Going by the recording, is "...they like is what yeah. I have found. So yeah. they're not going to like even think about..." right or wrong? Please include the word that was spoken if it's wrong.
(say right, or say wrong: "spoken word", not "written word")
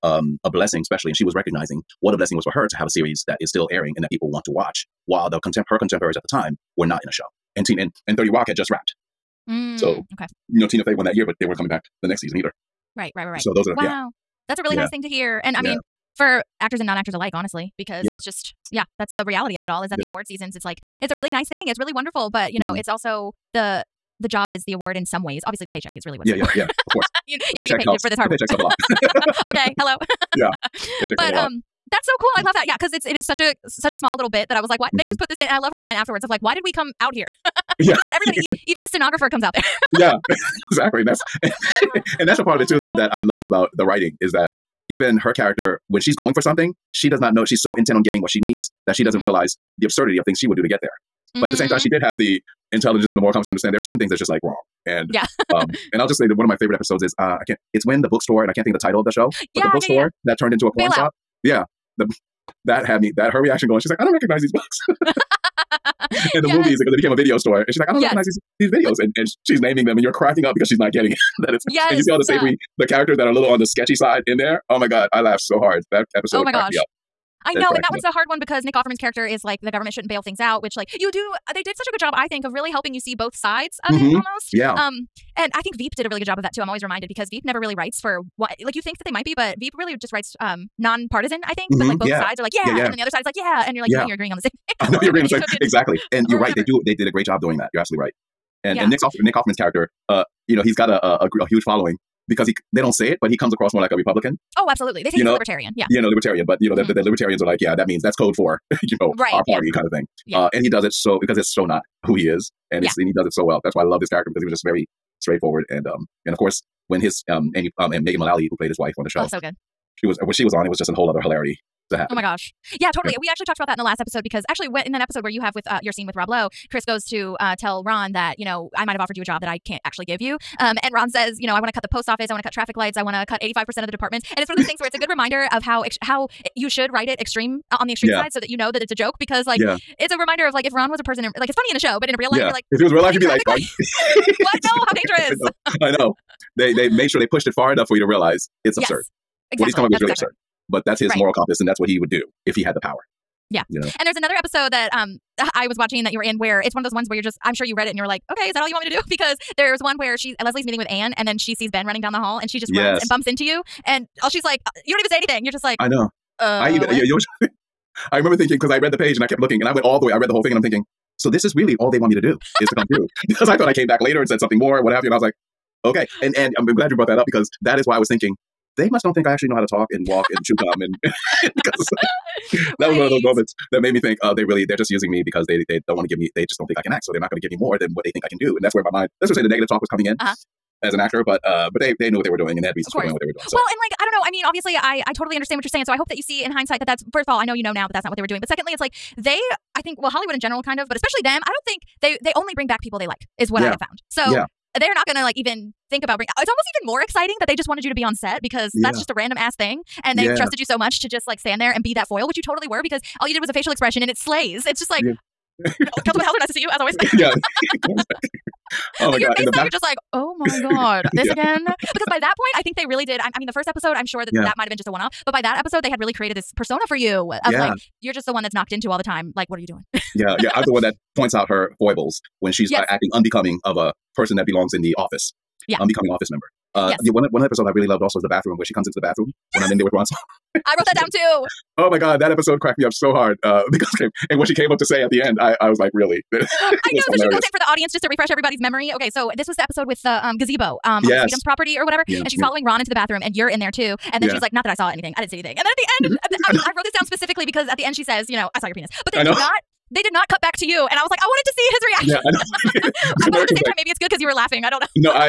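right.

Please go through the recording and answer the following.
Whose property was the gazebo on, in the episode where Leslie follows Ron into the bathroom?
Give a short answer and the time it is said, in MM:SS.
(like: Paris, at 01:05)
Sweetums, at 04:11.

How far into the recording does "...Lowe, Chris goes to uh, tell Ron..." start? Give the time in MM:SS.
02:06.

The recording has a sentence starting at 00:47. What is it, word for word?
She's so intent on getting what she needs that she doesn't mm-hmm.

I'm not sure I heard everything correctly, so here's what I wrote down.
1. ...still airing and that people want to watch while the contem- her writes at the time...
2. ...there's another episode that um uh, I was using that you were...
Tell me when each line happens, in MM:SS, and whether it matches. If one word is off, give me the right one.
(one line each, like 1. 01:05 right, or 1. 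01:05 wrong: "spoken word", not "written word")
1. 00:03 wrong: "contemporaries", not "writes"
2. 02:34 wrong: "watching", not "using".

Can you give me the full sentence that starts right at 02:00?
It was when she was on, it was just a whole other hilarity to happen.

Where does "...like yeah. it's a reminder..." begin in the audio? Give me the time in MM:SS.
02:19.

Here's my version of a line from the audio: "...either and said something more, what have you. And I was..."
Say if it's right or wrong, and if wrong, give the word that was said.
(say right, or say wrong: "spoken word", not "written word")
wrong: "later", not "either".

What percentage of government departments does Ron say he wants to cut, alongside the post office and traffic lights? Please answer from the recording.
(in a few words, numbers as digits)
85%.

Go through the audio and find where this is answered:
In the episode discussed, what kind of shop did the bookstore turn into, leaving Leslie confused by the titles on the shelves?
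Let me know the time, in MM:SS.
01:00.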